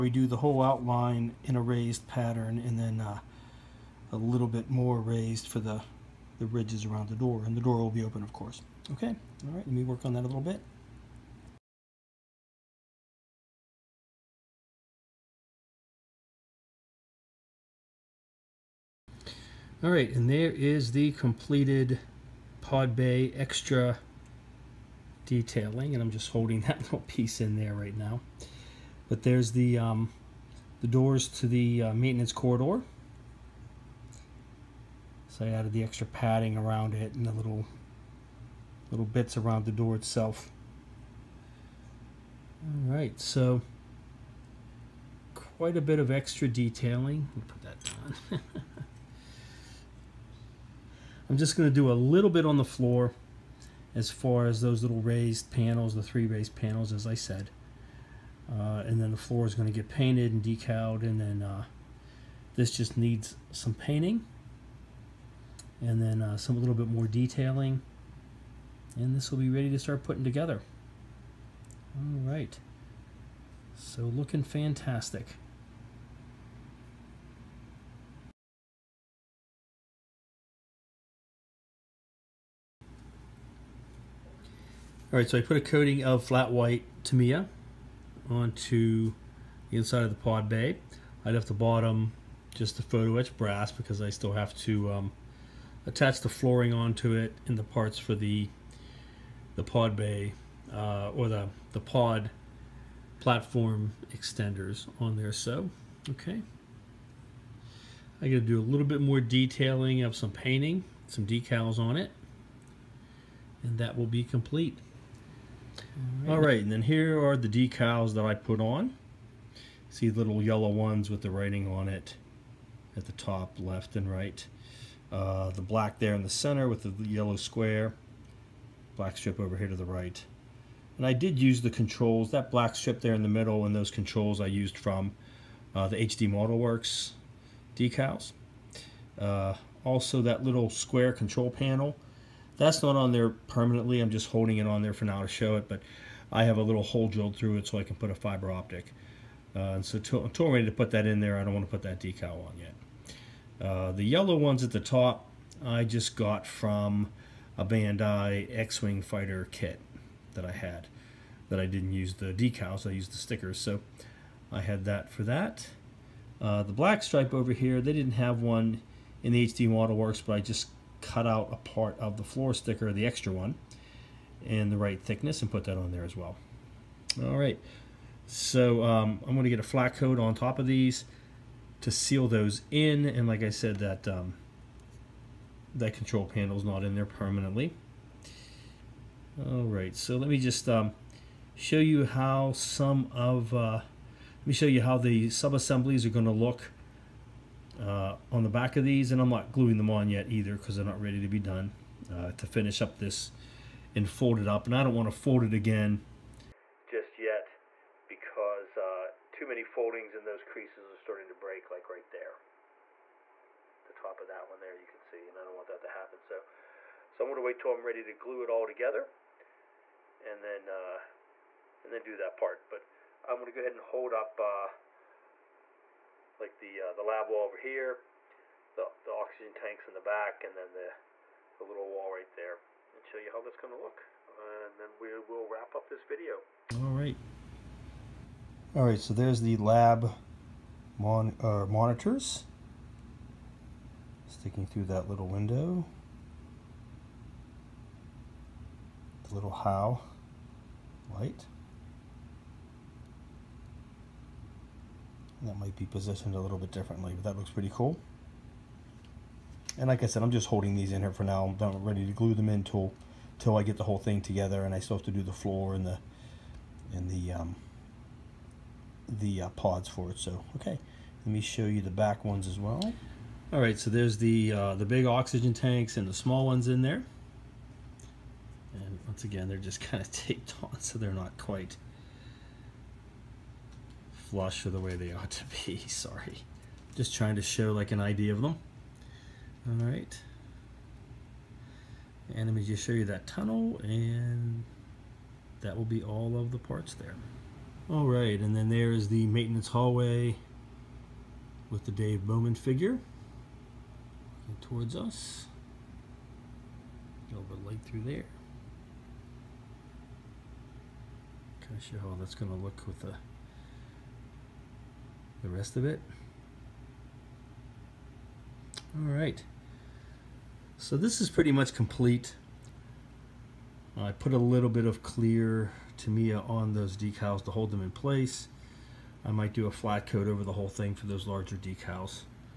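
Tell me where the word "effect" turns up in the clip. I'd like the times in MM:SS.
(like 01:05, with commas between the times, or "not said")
not said.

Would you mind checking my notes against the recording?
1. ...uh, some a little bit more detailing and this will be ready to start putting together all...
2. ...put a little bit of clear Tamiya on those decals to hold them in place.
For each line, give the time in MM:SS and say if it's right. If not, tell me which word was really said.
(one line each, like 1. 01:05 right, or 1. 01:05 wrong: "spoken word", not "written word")
1. 01:06 right
2. 05:24 right.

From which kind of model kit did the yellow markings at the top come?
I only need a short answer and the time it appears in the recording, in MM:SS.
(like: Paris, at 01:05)
Bandai X-Wing Fighter, at 02:37.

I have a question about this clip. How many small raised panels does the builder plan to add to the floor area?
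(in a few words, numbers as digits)
3.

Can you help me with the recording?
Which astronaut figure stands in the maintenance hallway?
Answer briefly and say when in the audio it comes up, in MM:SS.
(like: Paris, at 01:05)
Dave Bowman, at 05:01.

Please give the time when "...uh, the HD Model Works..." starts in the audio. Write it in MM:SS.
02:15.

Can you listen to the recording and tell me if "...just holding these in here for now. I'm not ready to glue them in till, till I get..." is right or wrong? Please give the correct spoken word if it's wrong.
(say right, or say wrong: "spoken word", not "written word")
right.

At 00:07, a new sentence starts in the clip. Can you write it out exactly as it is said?
And the door will be open, of course.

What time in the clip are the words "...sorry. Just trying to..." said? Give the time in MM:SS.
04:45.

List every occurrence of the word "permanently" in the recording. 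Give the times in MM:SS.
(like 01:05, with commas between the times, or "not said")
02:23, 03:07.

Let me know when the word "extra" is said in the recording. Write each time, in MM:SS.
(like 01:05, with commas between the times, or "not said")
00:23, 00:35, 00:46, 02:53.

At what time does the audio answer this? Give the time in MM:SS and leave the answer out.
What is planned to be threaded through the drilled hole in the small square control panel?
02:28.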